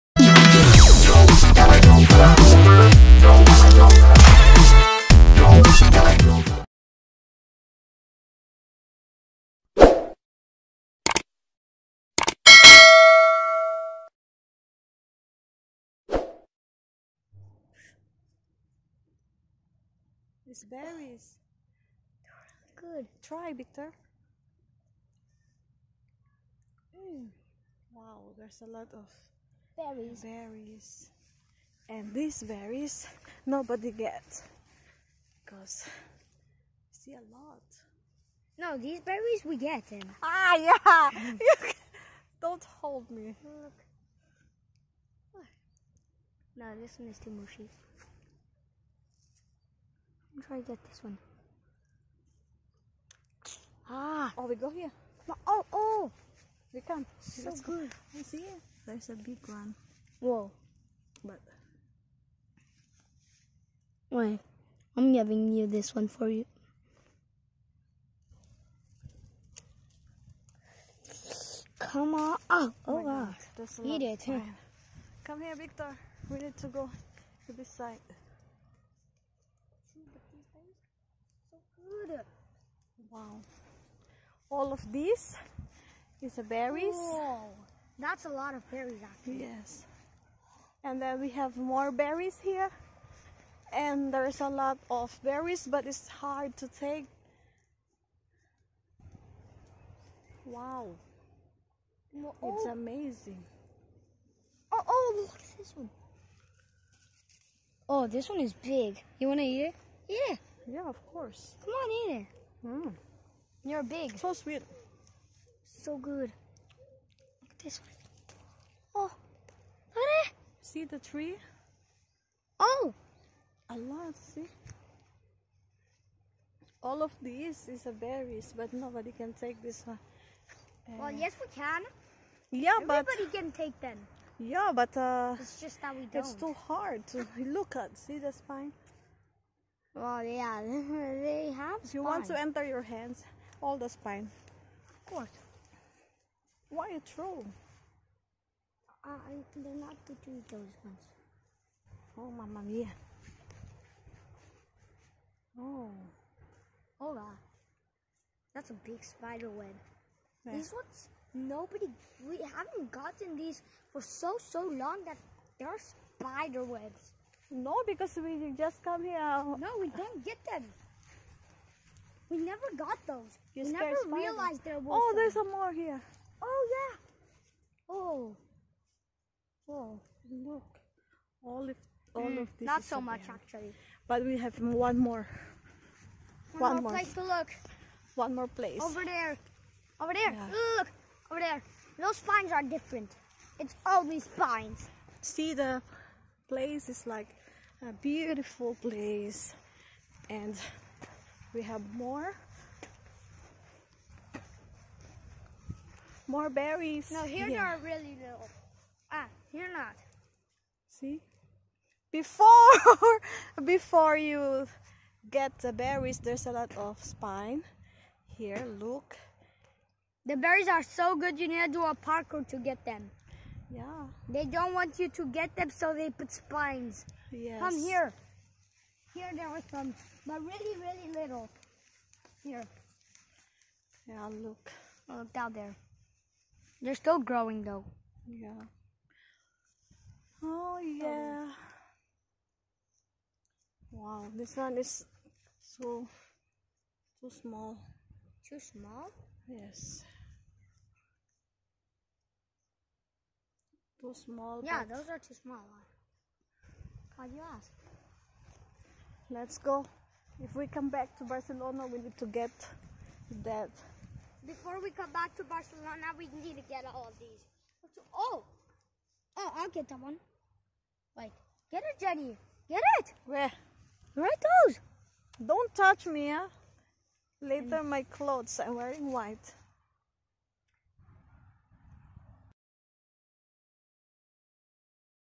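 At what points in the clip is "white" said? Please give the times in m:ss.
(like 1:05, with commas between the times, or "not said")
4:39.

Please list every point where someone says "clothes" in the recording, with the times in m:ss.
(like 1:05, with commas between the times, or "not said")
4:38.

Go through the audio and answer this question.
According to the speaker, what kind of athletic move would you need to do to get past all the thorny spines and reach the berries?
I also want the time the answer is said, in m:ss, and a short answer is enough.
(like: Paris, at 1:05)
parkour, at 3:41.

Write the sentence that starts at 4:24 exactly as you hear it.
Before we come back to Barcelona, we need to get all of these.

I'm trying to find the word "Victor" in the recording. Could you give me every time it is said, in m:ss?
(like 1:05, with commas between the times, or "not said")
0:23, 1:15.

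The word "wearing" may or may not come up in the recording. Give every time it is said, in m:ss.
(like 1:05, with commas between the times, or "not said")
4:38.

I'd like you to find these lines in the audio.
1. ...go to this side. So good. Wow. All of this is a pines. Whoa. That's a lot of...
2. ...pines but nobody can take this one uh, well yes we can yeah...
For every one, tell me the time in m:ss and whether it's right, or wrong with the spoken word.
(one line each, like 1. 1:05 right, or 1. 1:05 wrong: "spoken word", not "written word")
1. 1:16 wrong: "berries", not "pines"
2. 2:08 wrong: "berries", not "pines".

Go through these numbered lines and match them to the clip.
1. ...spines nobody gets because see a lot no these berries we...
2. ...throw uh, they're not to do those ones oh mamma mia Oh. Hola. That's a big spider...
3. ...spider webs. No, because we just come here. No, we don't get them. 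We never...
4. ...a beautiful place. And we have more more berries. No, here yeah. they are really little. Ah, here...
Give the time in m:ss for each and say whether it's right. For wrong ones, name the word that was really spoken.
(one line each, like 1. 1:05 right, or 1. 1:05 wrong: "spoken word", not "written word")
1. 0:32 wrong: "berries", not "spines"
2. 2:27 right
3. 2:45 right
4. 3:17 right.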